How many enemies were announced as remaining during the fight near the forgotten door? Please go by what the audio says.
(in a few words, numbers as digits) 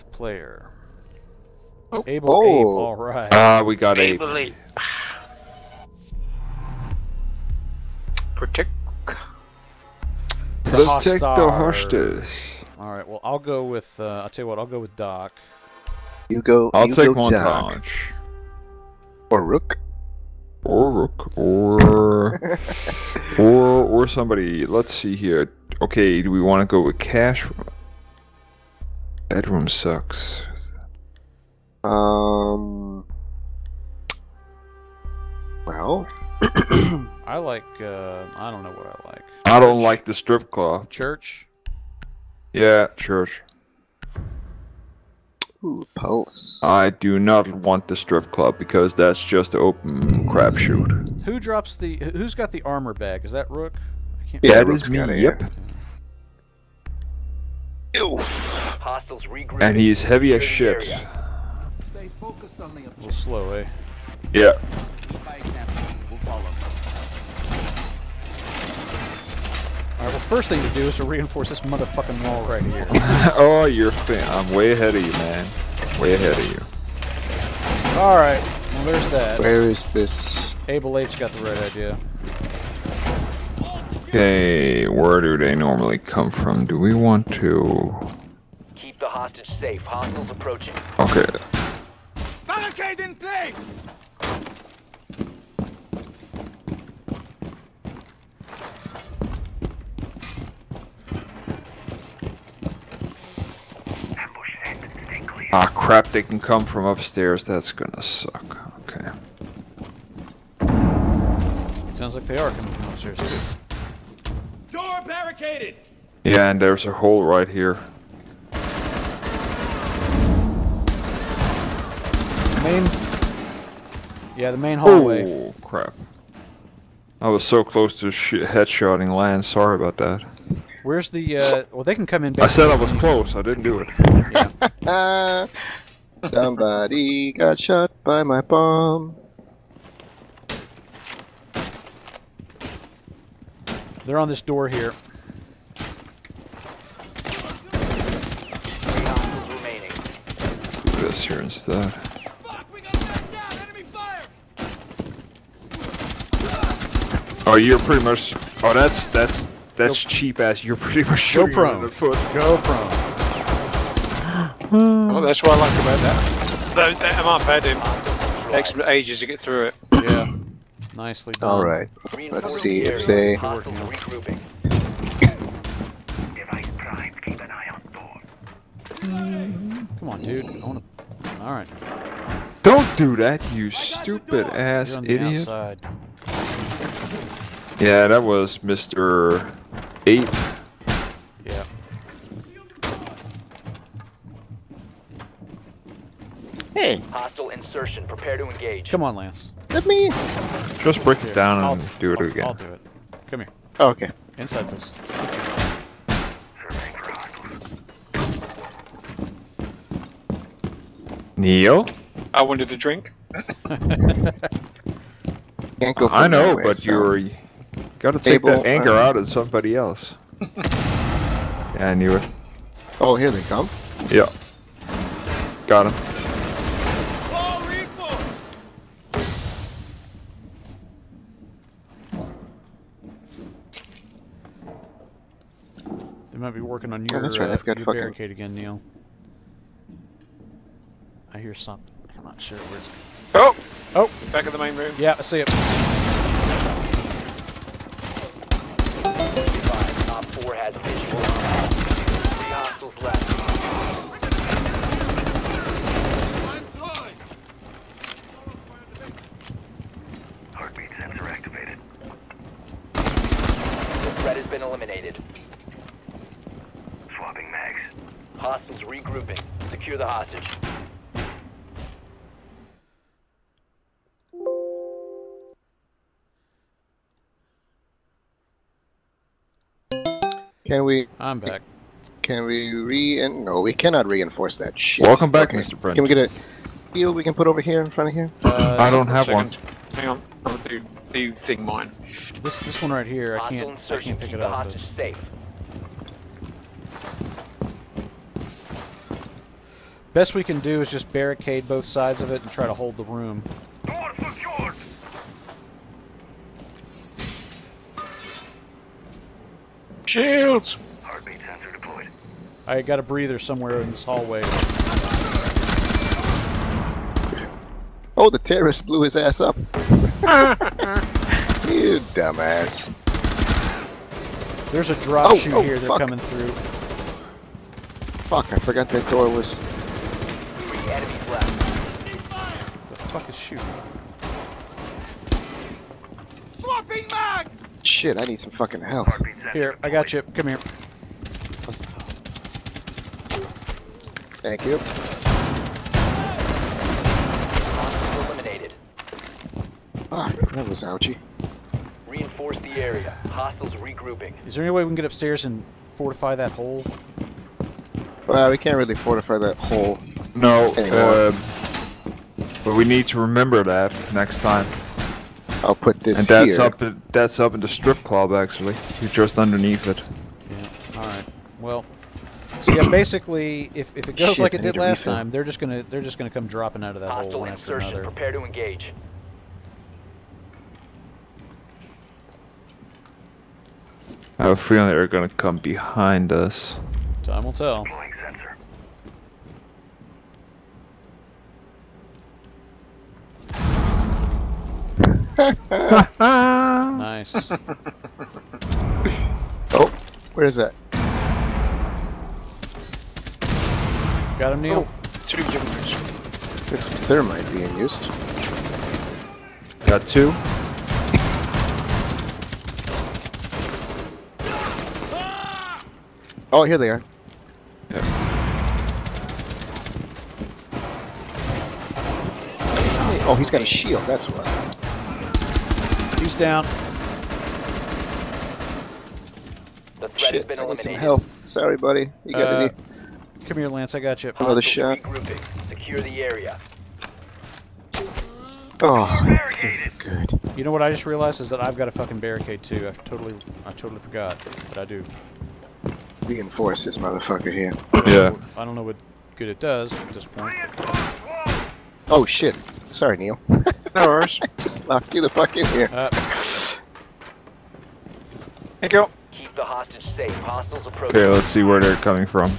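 3.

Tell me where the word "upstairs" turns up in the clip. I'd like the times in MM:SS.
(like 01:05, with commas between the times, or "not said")
01:46, 01:52, 05:55.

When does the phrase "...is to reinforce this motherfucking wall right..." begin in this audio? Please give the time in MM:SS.
01:10.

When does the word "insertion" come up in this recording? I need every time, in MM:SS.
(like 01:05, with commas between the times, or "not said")
03:17, 06:17.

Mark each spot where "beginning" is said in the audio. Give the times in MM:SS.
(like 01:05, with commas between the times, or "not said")
not said.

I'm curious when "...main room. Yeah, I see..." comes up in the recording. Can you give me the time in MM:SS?
04:04.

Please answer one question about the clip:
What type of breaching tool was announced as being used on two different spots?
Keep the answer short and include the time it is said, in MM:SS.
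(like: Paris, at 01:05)
thermite, at 06:46.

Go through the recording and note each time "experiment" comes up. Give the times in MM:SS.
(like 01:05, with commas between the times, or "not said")
not said.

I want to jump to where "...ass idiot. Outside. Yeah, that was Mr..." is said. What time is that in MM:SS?
03:04.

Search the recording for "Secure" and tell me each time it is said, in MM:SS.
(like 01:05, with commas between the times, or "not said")
04:29, 07:15.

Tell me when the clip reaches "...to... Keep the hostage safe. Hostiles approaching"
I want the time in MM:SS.
01:27.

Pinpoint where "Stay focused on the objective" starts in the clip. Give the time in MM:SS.
01:01.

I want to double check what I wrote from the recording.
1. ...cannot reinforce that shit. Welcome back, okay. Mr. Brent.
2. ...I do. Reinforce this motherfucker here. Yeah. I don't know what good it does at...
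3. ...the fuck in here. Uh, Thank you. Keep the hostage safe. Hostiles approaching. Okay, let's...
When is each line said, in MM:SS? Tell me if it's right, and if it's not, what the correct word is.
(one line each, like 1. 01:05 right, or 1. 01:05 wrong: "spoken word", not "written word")
1. 04:43 right
2. 07:24 right
3. 07:35 right.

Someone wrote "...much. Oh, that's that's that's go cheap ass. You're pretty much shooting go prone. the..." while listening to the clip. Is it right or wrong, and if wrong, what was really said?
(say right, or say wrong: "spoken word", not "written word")
right.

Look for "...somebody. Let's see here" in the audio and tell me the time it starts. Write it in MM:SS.
00:24.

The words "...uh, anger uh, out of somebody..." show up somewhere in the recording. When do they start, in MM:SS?
03:38.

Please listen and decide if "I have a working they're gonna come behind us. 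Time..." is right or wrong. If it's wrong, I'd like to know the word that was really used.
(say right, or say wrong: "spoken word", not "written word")
wrong: "feeling", not "working".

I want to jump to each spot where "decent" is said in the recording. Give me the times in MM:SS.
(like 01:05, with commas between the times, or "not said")
not said.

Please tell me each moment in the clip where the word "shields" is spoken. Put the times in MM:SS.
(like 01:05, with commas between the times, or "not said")
05:10, 07:03.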